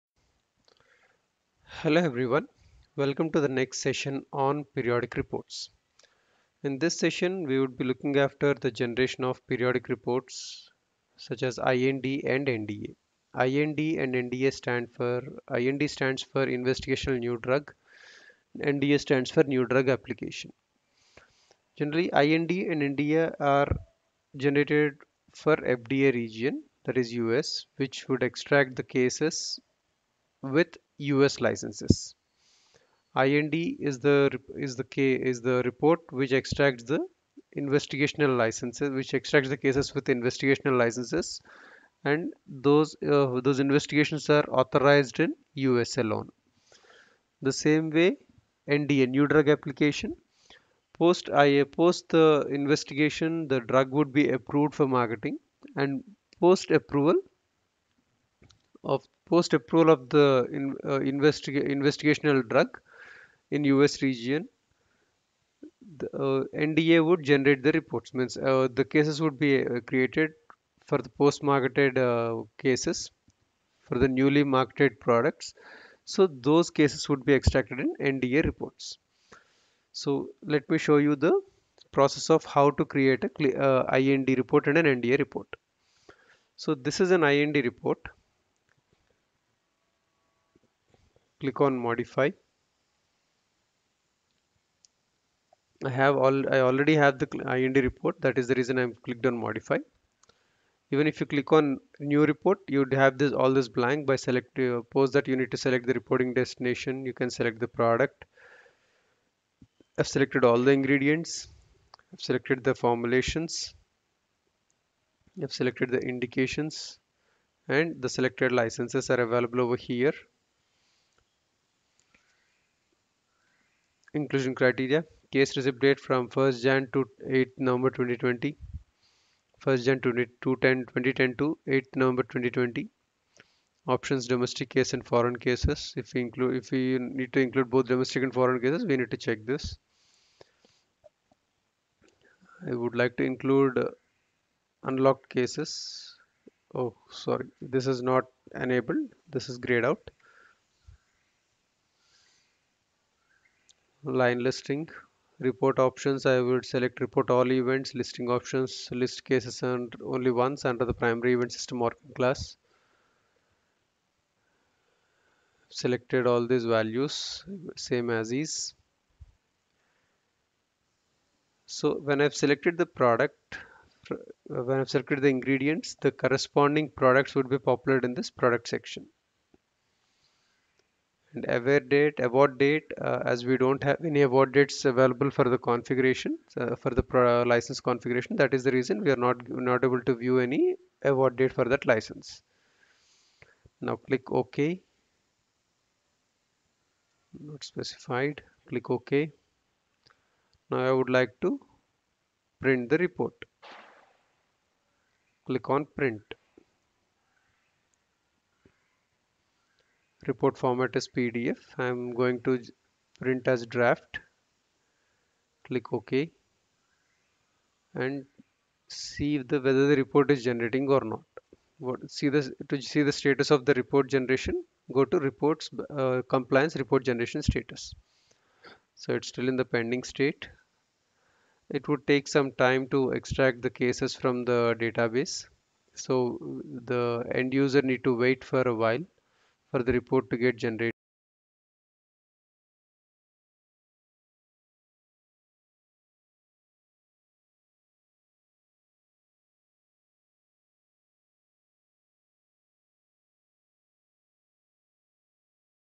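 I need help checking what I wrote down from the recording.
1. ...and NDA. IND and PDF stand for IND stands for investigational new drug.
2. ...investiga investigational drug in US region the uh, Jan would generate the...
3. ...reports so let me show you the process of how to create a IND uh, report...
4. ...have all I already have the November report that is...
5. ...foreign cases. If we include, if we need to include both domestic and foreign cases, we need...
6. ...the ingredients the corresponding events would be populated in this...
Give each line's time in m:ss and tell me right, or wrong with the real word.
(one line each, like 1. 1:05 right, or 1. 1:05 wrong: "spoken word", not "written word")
1. 0:12 wrong: "NDA", not "PDF"
2. 1:01 wrong: "NDA", not "Jan"
3. 1:18 right
4. 1:35 wrong: "IND", not "November"
5. 2:15 right
6. 2:55 wrong: "products", not "events".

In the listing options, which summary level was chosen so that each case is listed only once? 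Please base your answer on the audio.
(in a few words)
primary event.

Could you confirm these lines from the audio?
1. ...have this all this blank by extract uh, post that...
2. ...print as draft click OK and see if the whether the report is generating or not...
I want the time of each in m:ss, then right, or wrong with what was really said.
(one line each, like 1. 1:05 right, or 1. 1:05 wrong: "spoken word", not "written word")
1. 1:42 wrong: "select", not "extract"
2. 3:33 right.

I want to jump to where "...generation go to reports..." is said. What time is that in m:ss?
3:44.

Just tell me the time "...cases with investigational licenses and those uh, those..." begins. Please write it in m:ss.
0:39.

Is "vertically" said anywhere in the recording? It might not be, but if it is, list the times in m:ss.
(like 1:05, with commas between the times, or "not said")
not said.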